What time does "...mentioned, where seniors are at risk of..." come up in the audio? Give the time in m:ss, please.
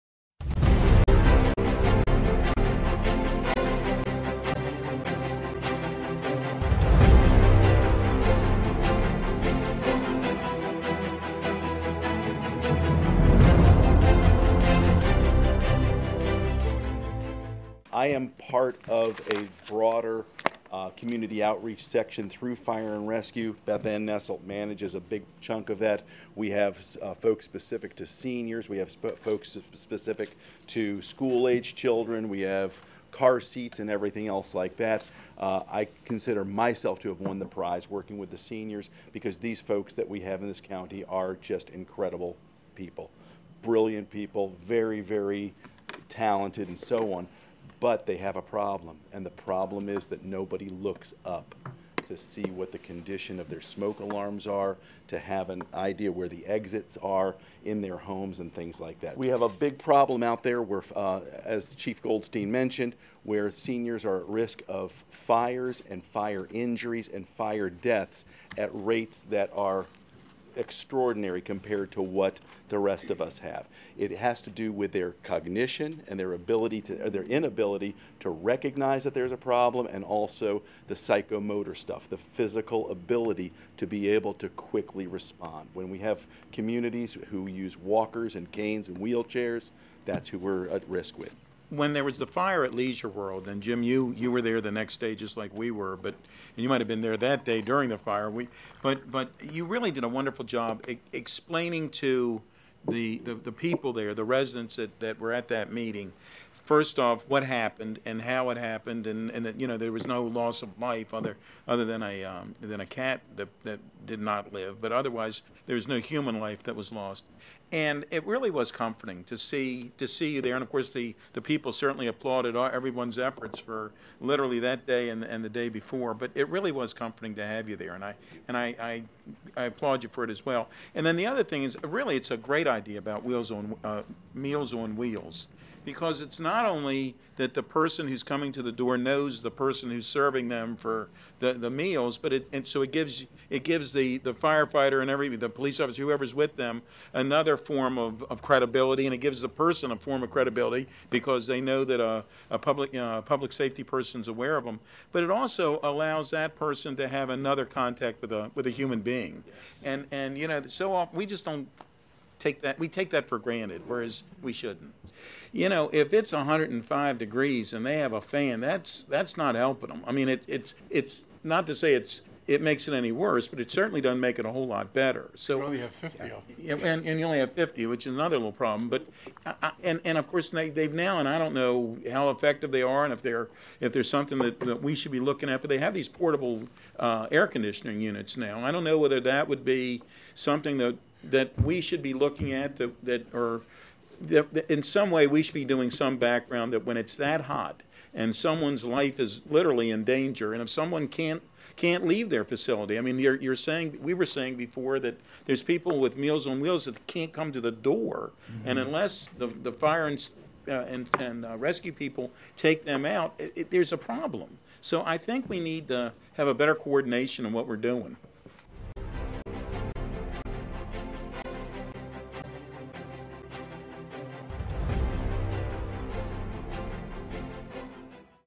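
1:02.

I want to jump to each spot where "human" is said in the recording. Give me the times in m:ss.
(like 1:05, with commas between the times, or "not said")
1:55, 2:38.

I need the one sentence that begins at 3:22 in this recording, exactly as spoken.
I mean, you're, you're saying, we were saying before that there's people with Meals on Wheels that can't come to the door.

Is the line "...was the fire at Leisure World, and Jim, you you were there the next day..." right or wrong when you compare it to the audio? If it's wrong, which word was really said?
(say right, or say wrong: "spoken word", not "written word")
right.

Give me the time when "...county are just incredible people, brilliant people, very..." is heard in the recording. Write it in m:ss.
0:40.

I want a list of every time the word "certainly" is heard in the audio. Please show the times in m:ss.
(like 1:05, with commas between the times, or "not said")
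2:01, 2:53.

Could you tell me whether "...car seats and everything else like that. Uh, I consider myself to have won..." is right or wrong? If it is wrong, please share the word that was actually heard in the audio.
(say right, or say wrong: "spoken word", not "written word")
right.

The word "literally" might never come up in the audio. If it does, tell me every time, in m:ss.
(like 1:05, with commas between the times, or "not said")
2:04, 3:19.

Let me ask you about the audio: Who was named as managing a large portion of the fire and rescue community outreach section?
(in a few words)
Beth Ann Nessel.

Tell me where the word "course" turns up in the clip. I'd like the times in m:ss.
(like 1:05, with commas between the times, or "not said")
2:00, 3:00.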